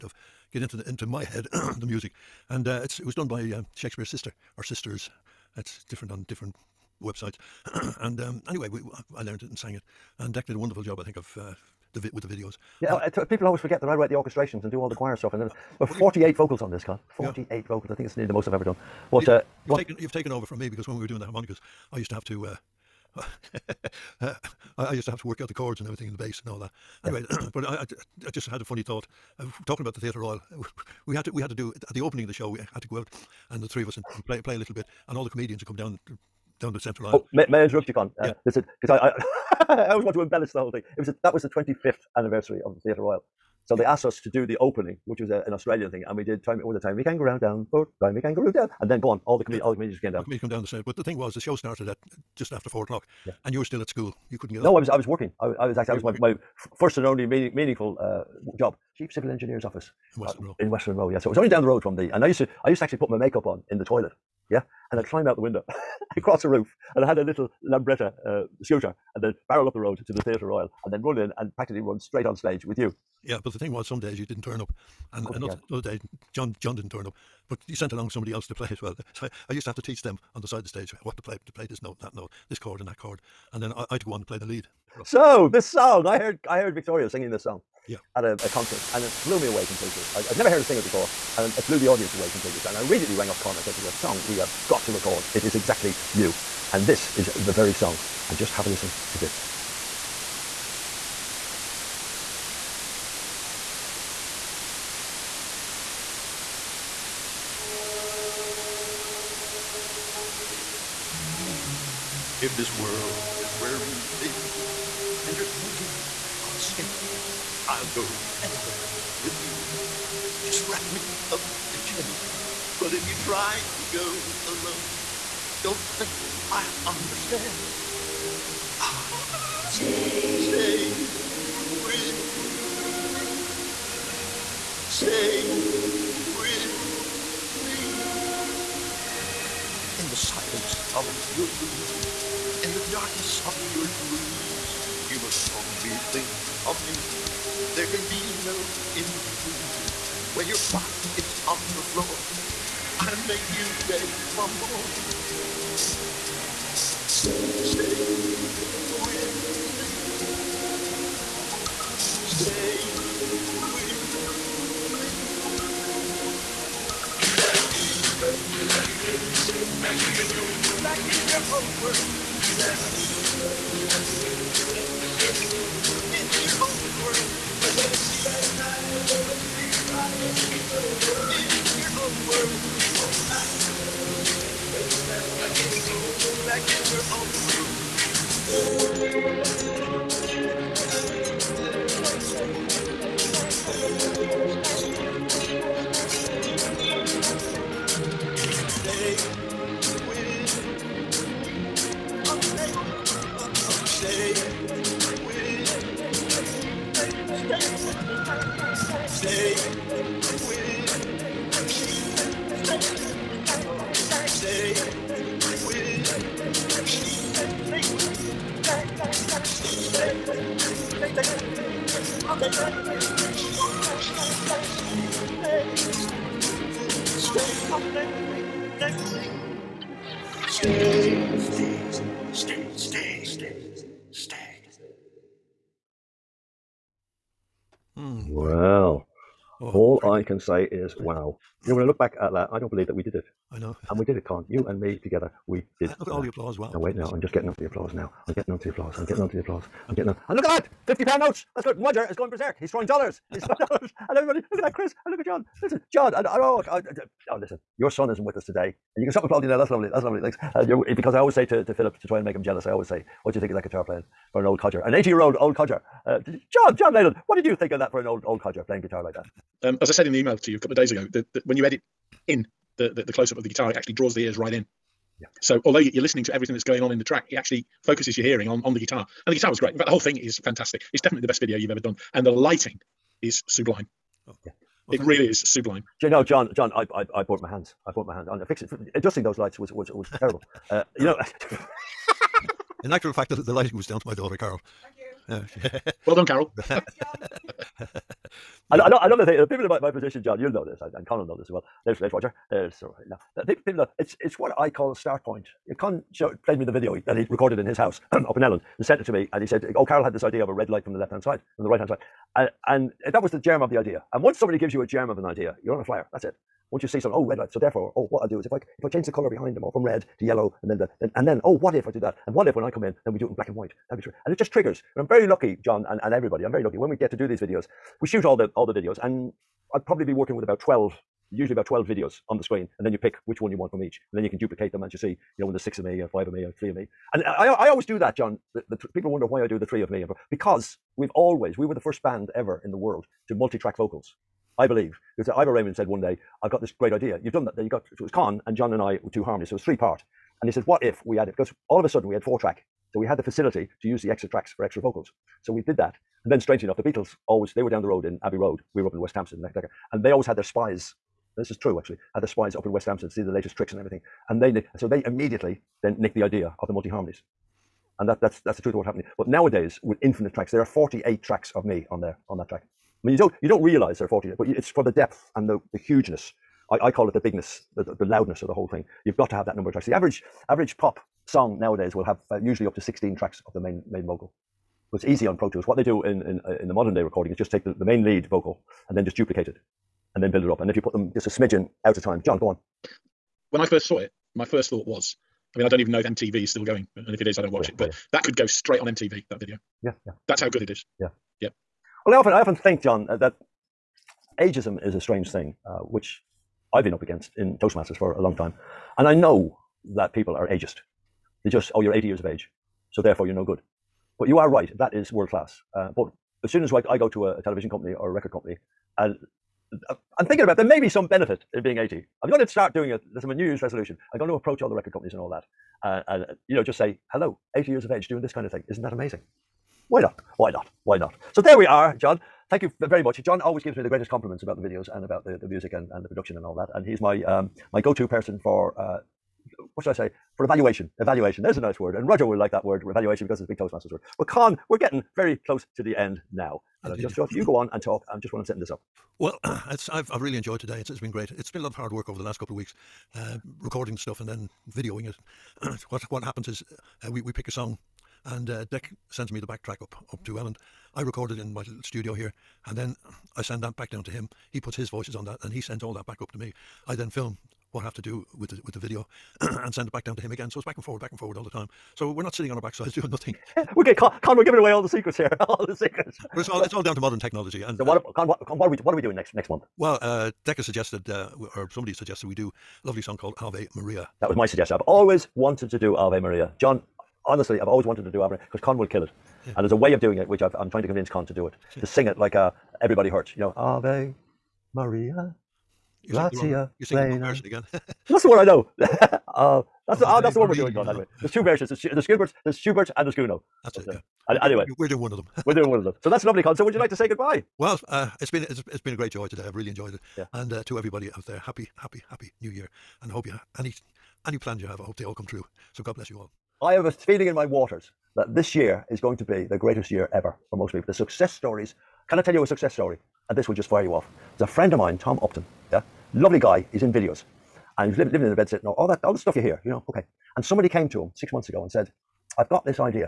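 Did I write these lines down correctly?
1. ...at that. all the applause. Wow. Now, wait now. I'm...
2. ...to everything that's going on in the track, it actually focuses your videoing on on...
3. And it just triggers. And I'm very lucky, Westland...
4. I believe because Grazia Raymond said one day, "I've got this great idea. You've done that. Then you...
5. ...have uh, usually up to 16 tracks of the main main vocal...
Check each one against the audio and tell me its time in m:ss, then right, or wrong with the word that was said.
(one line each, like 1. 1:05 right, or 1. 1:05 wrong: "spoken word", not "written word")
1. 4:06 right
2. 4:36 wrong: "hearing", not "videoing"
3. 5:24 wrong: "John", not "Westland"
4. 5:44 wrong: "Ivor", not "Grazia"
5. 6:22 right.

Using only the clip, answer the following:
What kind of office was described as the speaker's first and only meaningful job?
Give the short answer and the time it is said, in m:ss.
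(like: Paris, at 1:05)
chief civil engineer's office, at 0:58.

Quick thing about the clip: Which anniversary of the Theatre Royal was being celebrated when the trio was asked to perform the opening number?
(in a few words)
25th.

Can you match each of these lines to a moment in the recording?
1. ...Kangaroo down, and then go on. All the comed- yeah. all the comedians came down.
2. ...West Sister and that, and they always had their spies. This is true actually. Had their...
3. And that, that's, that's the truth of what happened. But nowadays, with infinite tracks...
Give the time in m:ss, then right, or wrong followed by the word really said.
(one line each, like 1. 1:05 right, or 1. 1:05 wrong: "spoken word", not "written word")
1. 0:48 right
2. 5:59 wrong: "Hampstead", not "Sister"
3. 6:07 right.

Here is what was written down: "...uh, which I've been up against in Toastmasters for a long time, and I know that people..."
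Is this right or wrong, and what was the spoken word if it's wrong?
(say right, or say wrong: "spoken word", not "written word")
right.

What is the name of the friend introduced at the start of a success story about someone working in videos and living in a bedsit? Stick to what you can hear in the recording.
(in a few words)
Tom Upton.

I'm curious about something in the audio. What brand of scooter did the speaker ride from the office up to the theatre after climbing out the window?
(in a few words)
Lambretta.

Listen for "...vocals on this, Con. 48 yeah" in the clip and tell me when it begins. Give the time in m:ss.
0:16.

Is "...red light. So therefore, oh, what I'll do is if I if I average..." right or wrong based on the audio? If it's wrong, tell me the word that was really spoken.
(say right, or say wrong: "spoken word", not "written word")
wrong: "change", not "average".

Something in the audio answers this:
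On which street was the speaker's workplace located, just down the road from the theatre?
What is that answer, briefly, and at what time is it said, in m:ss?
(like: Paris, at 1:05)
Westland Row, at 1:00.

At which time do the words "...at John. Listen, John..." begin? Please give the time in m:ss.
4:15.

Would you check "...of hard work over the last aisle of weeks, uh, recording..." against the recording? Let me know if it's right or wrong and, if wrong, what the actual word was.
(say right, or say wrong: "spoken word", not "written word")
wrong: "couple", not "aisle".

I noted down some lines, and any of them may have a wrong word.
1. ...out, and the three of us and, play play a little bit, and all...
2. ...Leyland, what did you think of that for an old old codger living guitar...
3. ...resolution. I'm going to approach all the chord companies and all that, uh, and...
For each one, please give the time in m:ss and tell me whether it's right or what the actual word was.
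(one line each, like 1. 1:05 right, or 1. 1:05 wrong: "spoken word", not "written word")
1. 0:33 right
2. 4:26 wrong: "playing", not "living"
3. 7:03 wrong: "record", not "chord".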